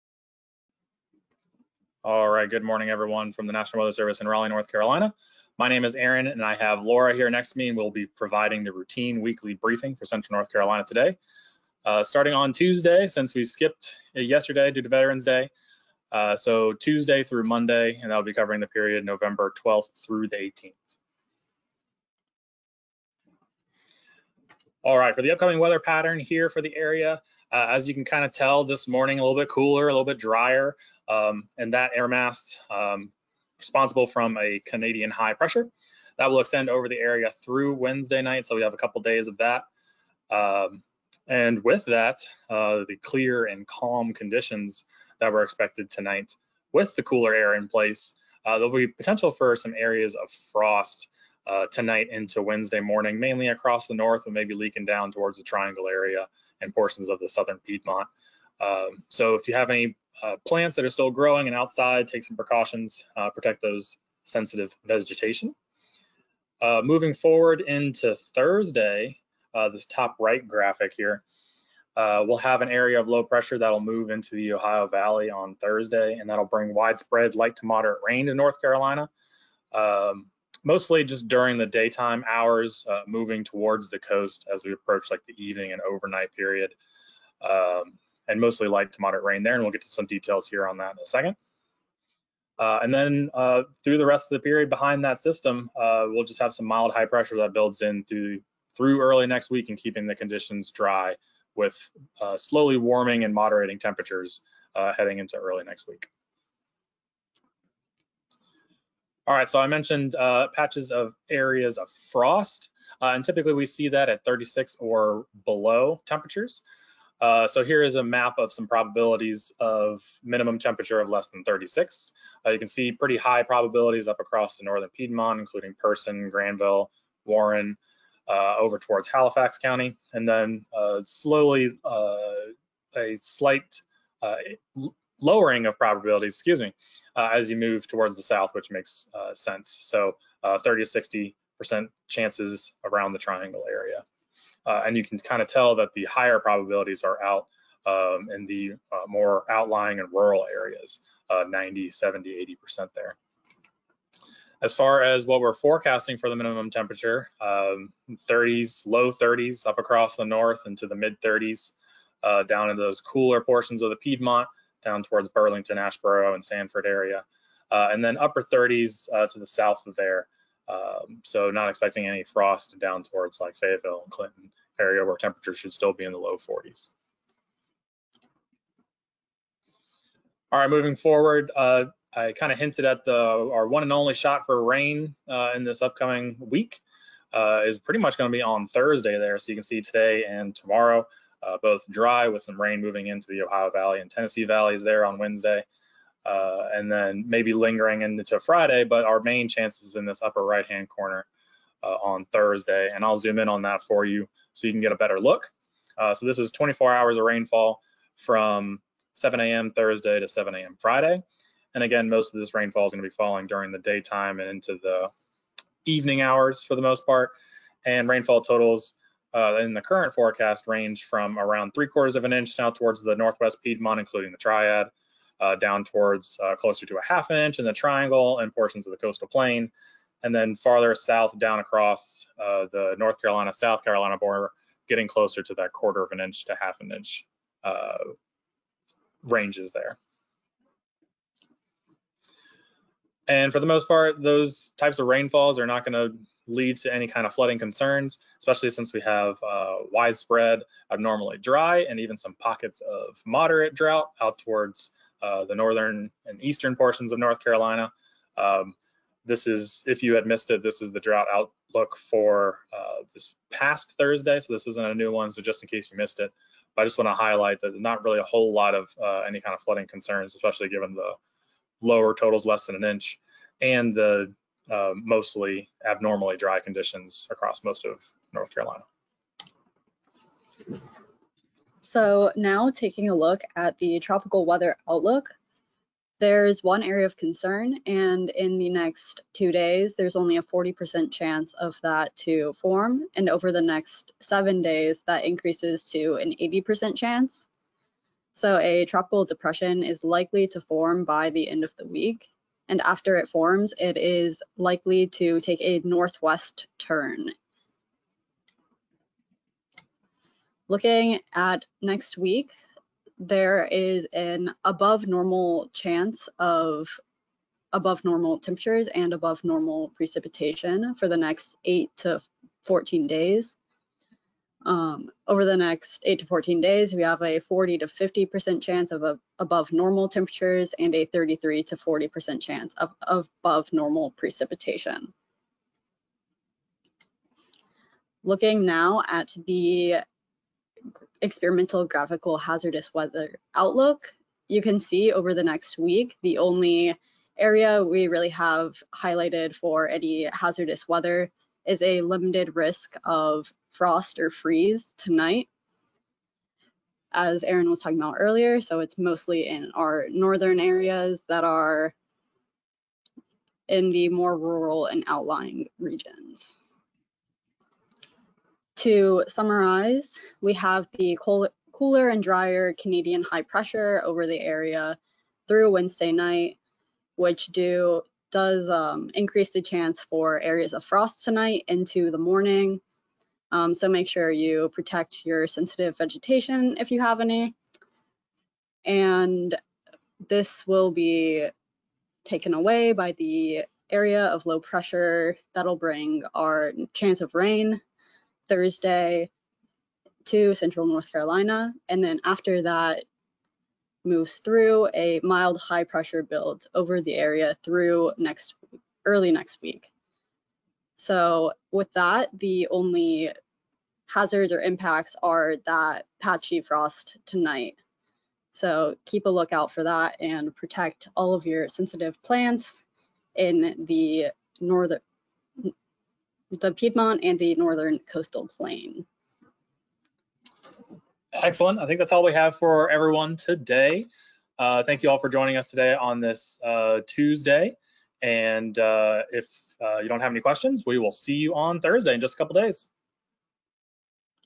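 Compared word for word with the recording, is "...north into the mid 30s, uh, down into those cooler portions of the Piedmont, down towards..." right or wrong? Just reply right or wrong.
right.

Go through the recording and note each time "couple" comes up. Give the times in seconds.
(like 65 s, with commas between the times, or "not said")
38 s, 442 s.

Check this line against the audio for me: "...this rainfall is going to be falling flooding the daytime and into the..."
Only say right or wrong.
wrong.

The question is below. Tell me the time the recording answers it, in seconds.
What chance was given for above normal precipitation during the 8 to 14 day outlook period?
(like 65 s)
331 s.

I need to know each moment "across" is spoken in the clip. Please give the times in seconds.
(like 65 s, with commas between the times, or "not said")
53 s, 124 s, 159 s, 231 s, 277 s.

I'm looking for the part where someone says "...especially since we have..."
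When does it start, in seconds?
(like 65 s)
248 s.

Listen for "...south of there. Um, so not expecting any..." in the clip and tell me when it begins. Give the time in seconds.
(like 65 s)
169 s.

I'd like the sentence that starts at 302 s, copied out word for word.
And after it forms, it is likely to take a northwest turn.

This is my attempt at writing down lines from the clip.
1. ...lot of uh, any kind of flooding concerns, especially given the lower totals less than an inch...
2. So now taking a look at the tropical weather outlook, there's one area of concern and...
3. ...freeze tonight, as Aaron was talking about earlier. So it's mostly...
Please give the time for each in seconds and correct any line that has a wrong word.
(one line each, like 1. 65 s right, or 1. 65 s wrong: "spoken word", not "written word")
1. 268 s right
2. 281 s right
3. 354 s right.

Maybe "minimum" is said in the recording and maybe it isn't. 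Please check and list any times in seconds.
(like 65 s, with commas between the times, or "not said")
120 s, 156 s.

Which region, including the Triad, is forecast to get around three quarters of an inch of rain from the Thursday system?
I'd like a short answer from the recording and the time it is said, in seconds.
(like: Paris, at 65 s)
northwest Piedmont, at 223 s.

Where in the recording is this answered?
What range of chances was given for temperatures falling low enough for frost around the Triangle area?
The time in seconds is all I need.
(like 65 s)
140 s.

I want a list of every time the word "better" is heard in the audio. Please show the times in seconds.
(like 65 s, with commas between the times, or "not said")
204 s.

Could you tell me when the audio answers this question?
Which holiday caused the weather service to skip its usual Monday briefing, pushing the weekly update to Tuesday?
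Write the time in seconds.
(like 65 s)
14 s.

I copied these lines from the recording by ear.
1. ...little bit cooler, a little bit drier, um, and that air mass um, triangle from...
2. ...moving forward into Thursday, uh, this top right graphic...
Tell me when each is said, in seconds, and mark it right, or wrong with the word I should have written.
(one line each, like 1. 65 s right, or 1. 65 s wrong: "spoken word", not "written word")
1. 29 s wrong: "responsible", not "triangle"
2. 66 s right.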